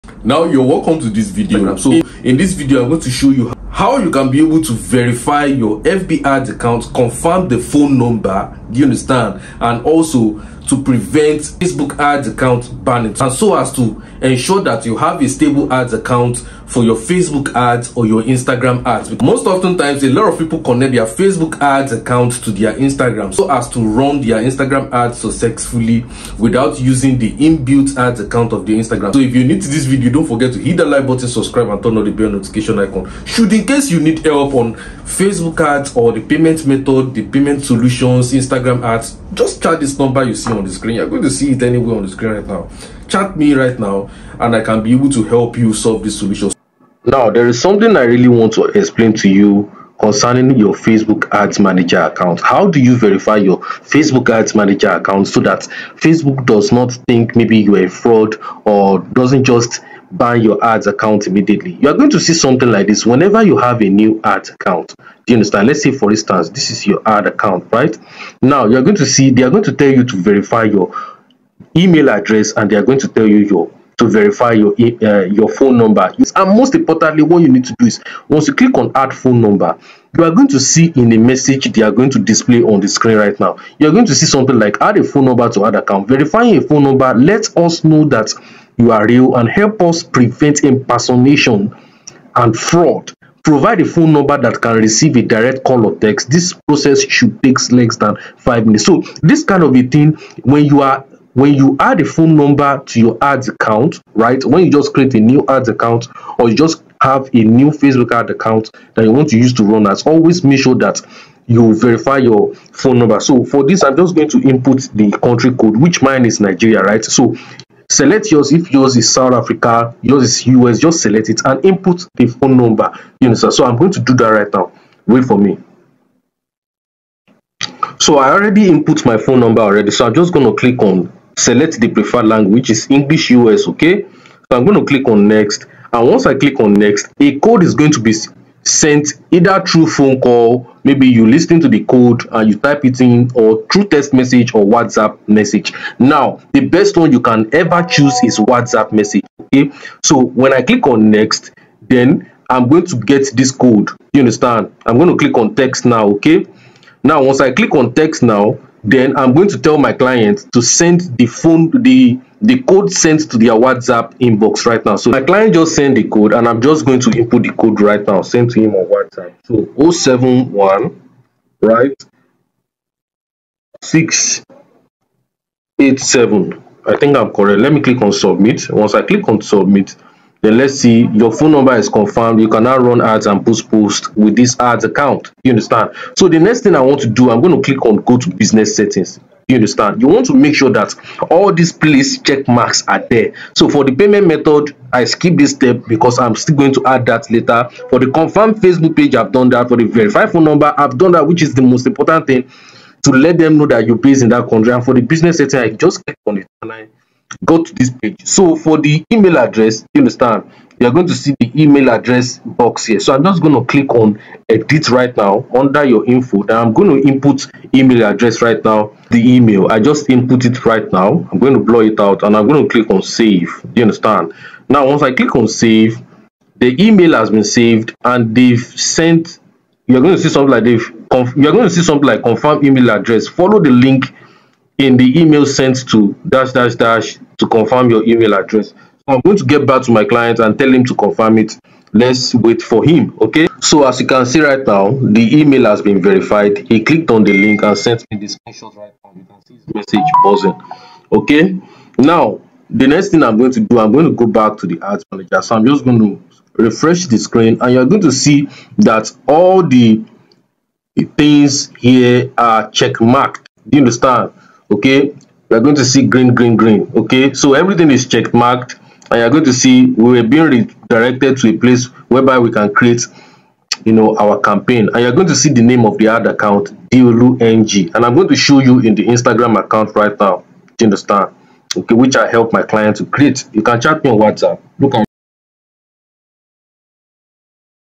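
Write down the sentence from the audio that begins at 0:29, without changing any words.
So if you need this video, don't forget to hit the like button, subscribe and turn on the bell notification icon.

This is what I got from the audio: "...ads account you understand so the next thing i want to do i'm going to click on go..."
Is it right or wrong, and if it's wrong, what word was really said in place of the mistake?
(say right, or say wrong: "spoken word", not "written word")
right.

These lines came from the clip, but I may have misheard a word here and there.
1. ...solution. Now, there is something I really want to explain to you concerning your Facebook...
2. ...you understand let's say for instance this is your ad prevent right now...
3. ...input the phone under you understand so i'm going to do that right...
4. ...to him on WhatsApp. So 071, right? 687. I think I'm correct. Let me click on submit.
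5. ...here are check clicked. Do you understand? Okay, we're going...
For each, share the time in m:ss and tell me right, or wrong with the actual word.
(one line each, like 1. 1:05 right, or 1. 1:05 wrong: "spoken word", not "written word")
1. 0:46 right
2. 1:05 wrong: "account", not "prevent"
3. 2:01 wrong: "number", not "under"
4. 2:48 right
5. 4:21 wrong: "marked", not "clicked".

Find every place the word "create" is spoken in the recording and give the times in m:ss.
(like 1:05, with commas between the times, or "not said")
1:44, 4:32, 4:43.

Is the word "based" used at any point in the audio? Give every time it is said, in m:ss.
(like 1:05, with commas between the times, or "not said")
3:23.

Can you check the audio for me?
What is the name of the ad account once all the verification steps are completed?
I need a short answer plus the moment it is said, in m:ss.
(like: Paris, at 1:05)
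DLUNG, at 4:36.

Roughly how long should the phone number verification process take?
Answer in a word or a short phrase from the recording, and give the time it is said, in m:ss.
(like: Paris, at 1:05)
less than five minutes, at 1:37.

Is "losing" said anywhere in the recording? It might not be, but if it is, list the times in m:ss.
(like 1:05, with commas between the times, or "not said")
not said.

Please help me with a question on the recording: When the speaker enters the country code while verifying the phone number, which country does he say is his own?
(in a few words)
Nigeria.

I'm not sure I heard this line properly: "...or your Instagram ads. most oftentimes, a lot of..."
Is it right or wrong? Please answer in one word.
right.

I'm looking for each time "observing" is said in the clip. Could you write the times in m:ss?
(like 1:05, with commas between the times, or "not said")
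not said.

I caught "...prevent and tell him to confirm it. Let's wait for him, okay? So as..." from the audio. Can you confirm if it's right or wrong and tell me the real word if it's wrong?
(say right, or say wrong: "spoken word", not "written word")
wrong: "client", not "prevent".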